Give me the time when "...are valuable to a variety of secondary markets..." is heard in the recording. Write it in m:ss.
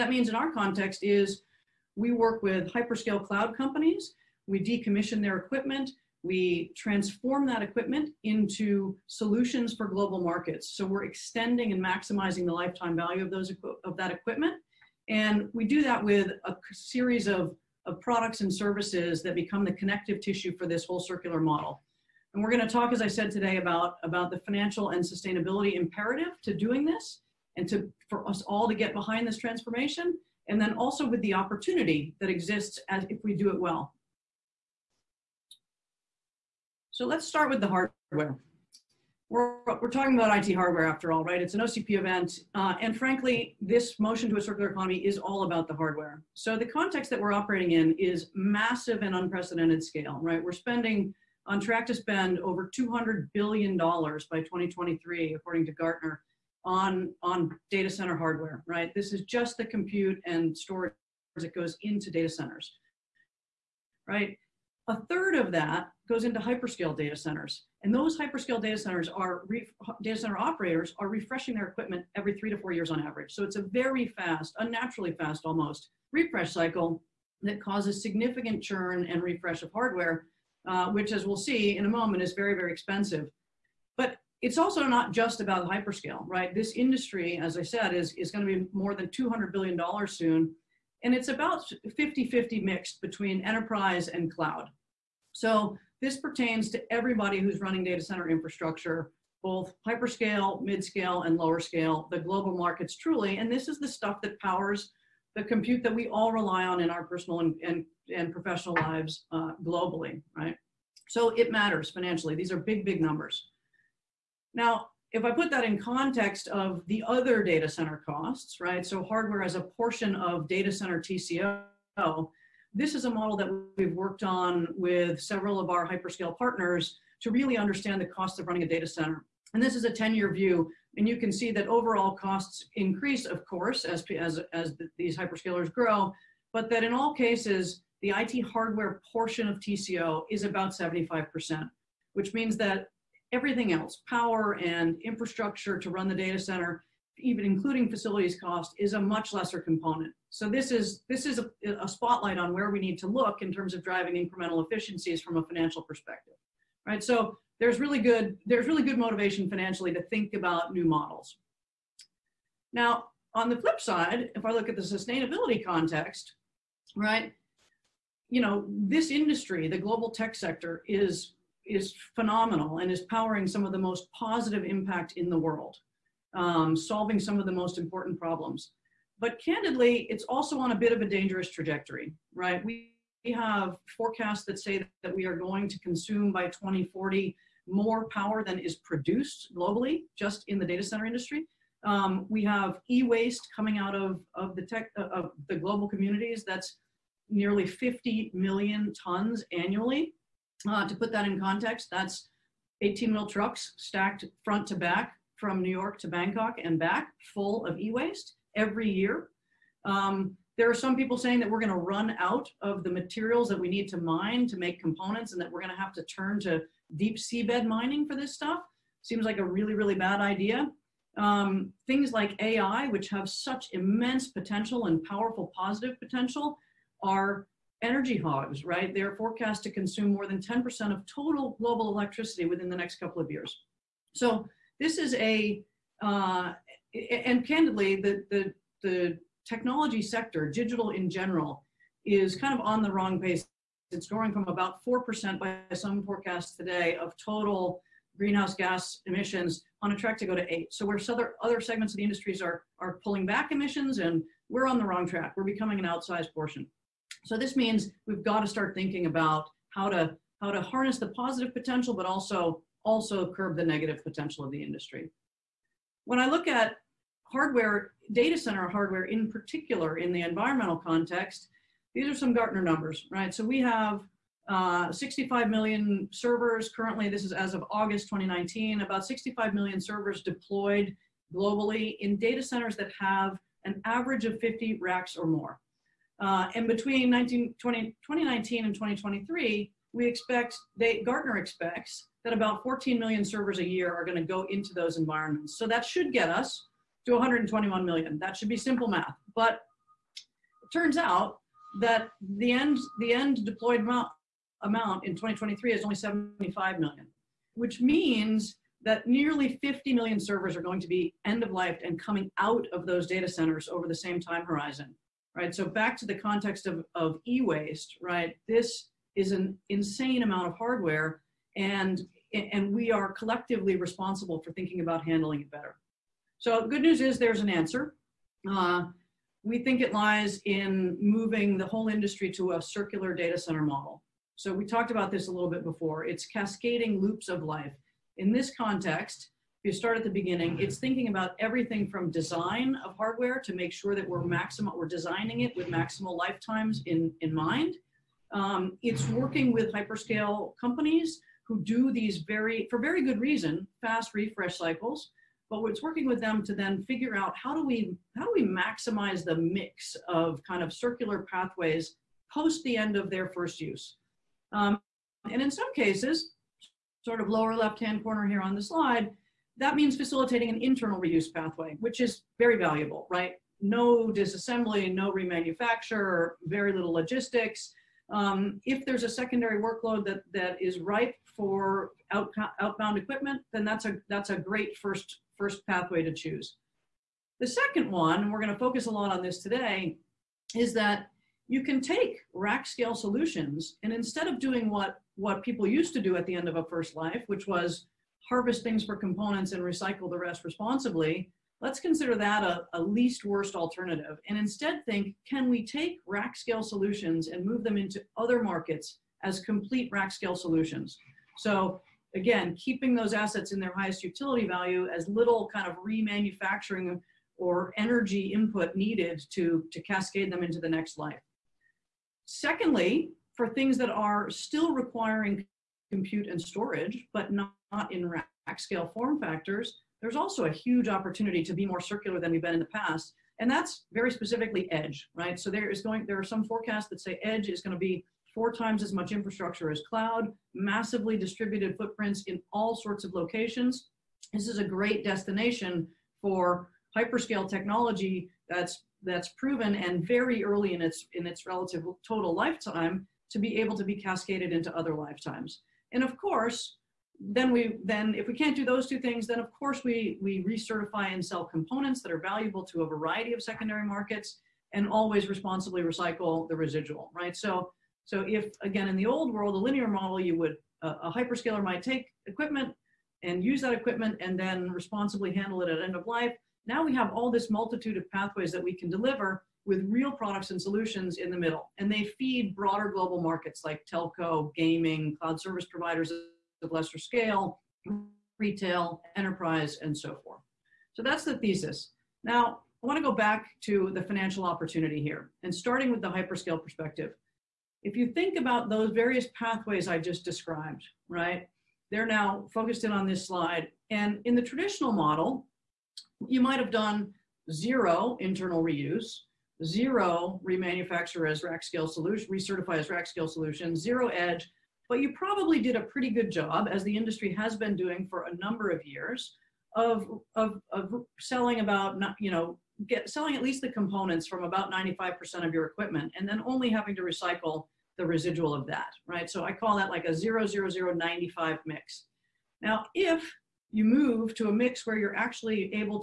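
7:42.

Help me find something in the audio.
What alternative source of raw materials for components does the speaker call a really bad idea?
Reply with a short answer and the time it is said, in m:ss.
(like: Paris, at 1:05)
deep seabed mining, at 3:36.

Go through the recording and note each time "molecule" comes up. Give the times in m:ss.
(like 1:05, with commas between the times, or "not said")
not said.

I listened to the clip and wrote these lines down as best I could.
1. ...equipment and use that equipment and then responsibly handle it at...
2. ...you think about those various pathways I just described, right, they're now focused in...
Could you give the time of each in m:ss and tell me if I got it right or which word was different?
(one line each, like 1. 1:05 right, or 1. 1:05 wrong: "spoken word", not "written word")
1. 7:52 right
2. 8:17 right.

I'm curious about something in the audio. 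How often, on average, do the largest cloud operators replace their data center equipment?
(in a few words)
every 3 to 4 years.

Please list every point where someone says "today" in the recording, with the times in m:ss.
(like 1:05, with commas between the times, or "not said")
0:23, 4:06, 6:29.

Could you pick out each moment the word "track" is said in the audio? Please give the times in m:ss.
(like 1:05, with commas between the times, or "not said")
0:51, 4:09, 4:15.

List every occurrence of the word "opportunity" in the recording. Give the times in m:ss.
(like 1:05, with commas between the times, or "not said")
0:31, 7:10, 8:14.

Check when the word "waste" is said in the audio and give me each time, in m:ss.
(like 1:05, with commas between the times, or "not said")
3:12, 3:27, 5:17.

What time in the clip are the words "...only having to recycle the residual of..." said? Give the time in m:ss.
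8:46.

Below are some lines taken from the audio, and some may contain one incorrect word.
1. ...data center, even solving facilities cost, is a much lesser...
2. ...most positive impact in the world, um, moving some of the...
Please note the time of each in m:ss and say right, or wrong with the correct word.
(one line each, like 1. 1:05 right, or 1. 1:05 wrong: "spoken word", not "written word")
1. 2:26 wrong: "including", not "solving"
2. 2:53 wrong: "solving", not "moving".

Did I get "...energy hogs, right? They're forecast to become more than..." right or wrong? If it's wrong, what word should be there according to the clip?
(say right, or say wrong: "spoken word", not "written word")
wrong: "consume", not "become".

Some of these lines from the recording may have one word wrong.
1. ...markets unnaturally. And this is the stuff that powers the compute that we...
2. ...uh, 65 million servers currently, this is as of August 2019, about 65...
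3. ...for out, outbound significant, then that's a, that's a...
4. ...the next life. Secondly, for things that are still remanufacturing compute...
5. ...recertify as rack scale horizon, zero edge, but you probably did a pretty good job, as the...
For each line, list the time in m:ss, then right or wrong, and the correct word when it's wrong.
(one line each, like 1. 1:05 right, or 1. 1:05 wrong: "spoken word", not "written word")
1. 1:42 wrong: "truly", not "unnaturally"
2. 4:34 right
3. 6:21 wrong: "equipment", not "significant"
4. 7:00 wrong: "requiring", not "remanufacturing"
5. 8:32 wrong: "solution", not "horizon".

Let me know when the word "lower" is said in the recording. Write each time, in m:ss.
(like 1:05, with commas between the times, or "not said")
1:41, 6:07.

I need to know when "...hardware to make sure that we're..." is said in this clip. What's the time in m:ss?
5:42.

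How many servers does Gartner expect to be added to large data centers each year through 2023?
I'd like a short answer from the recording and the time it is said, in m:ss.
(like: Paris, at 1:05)
14 million, at 4:52.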